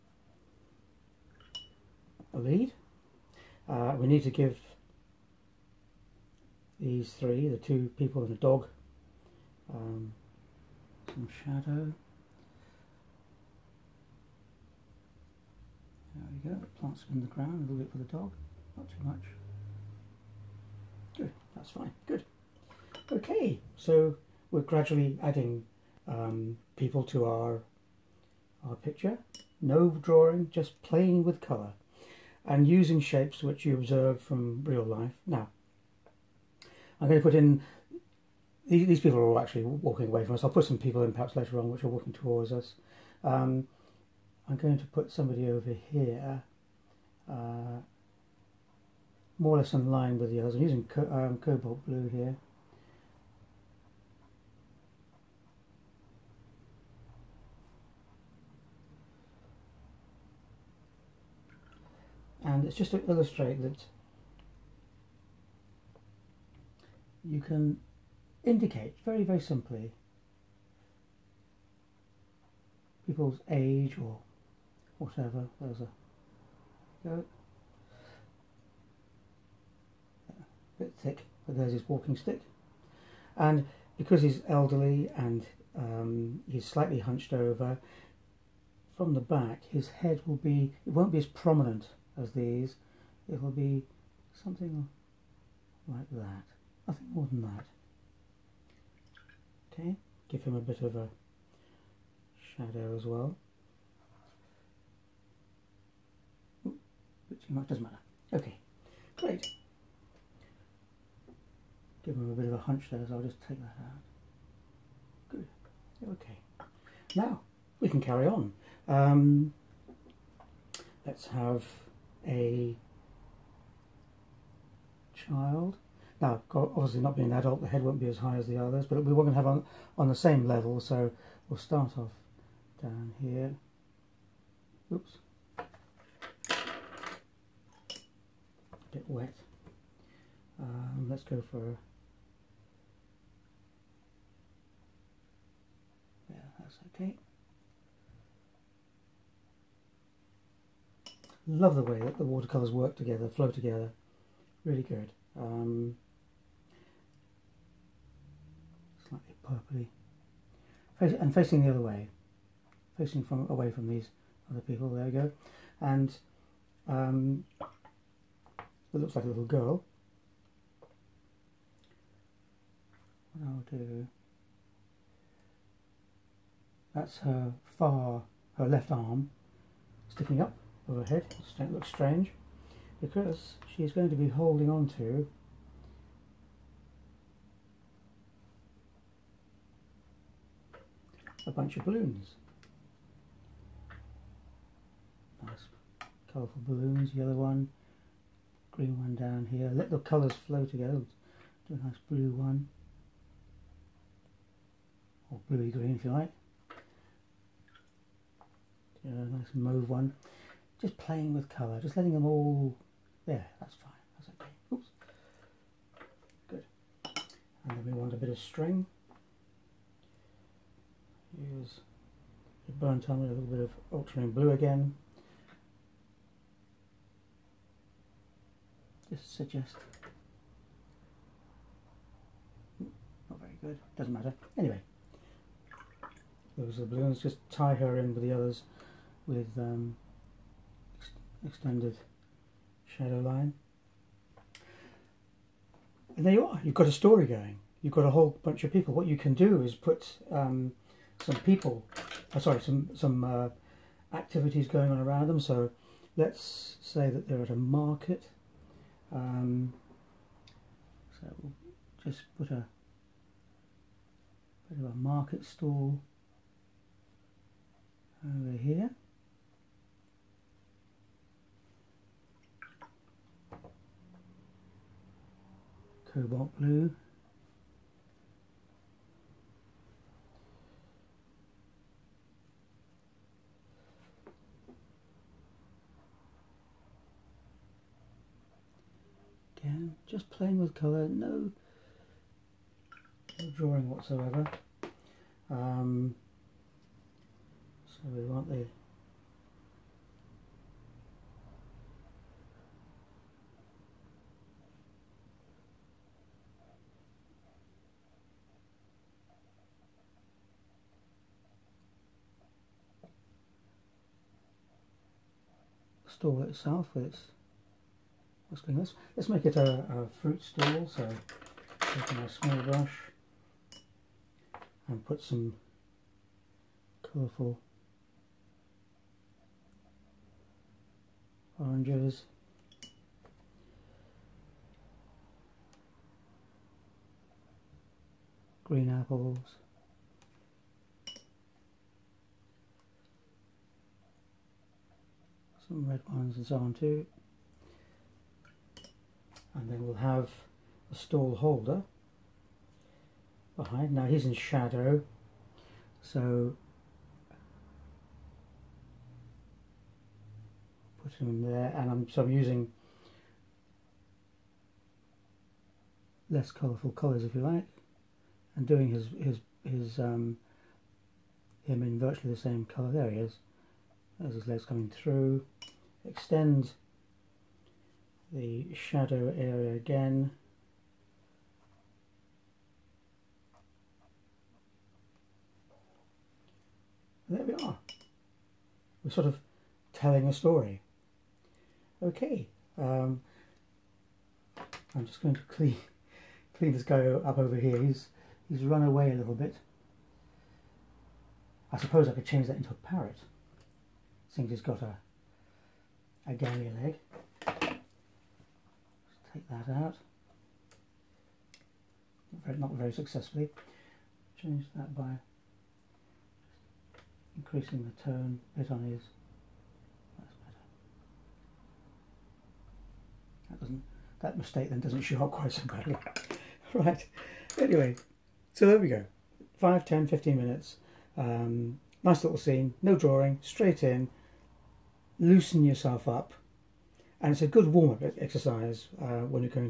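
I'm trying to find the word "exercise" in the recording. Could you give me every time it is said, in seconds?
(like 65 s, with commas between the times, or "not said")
438 s.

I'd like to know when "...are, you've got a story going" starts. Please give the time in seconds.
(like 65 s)
246 s.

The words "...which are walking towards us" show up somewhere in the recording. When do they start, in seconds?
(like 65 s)
41 s.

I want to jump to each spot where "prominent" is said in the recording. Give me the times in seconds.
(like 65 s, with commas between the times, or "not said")
91 s.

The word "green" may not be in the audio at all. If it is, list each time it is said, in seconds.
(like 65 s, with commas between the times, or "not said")
198 s, 205 s, 338 s.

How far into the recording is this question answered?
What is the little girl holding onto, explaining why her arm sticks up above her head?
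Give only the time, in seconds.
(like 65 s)
191 s.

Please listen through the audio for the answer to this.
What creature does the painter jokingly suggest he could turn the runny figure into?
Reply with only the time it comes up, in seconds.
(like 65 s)
402 s.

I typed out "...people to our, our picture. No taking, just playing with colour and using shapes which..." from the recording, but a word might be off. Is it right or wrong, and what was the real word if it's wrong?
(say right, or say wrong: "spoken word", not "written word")
wrong: "drawing", not "taking".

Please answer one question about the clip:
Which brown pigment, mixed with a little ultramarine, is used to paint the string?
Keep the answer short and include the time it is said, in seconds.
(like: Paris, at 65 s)
burnt umber, at 222 s.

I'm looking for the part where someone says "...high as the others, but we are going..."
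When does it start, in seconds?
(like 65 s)
128 s.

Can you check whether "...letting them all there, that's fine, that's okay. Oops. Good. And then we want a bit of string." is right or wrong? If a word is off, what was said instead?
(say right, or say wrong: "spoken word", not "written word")
right.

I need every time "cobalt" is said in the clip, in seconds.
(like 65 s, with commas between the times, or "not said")
51 s, 276 s.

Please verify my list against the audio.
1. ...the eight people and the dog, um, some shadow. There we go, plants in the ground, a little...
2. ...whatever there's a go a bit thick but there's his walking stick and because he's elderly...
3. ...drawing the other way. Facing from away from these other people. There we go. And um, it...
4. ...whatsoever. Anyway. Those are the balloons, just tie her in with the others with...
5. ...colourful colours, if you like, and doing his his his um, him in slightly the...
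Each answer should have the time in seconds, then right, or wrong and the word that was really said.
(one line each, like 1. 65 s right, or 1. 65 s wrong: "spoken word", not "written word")
1. 7 s wrong: "two", not "eight"
2. 74 s right
3. 161 s wrong: "facing", not "drawing"
4. 234 s wrong: "matter", not "whatsoever"
5. 366 s wrong: "virtually", not "slightly".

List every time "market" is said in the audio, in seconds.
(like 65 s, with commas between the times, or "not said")
257 s, 264 s.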